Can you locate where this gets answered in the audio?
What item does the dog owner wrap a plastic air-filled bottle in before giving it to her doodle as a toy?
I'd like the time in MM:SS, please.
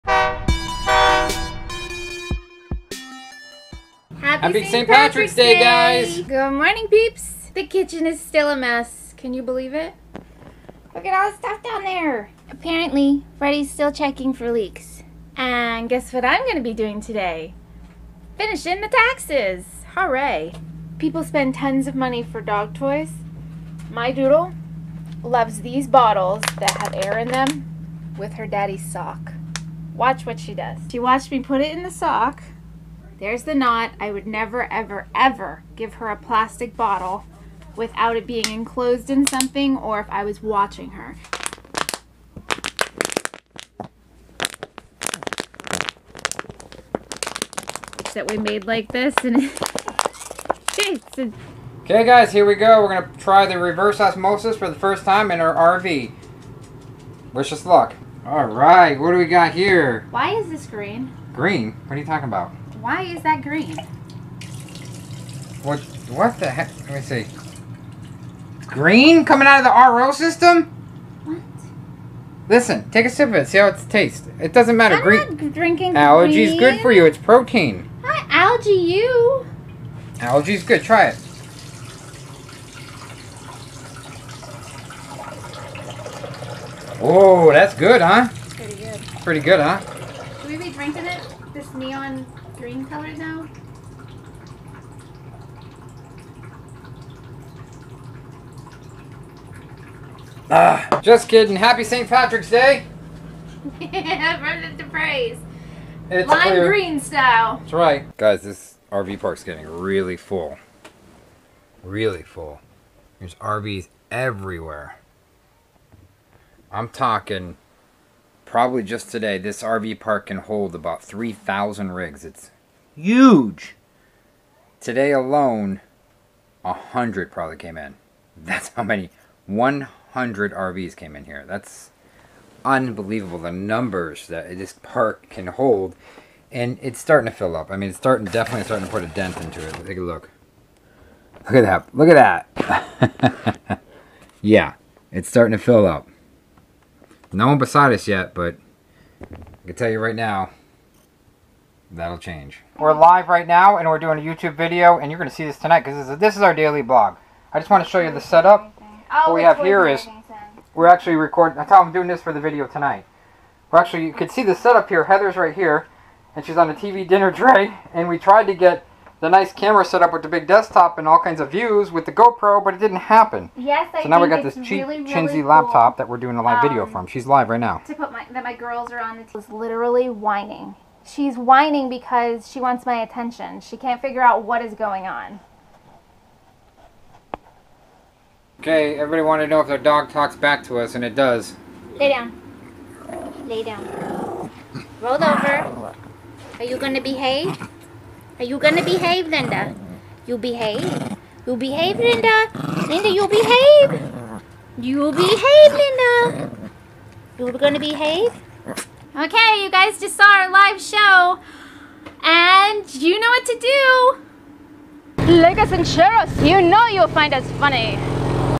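00:28.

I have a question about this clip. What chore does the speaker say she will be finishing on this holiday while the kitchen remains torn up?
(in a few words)
The taxes.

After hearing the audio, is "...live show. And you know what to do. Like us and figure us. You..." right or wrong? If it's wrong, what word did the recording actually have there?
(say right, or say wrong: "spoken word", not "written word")
wrong: "share", not "figure".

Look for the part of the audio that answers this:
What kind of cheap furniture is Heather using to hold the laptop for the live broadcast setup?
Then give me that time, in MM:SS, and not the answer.
02:46.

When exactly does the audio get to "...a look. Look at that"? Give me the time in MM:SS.
02:19.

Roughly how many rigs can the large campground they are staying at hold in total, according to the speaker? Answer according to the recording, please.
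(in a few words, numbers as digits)
3,000.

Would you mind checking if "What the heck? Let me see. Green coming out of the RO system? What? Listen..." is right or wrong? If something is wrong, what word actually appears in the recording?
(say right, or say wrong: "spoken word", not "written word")
right.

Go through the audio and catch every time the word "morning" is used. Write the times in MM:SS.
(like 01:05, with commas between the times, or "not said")
00:06.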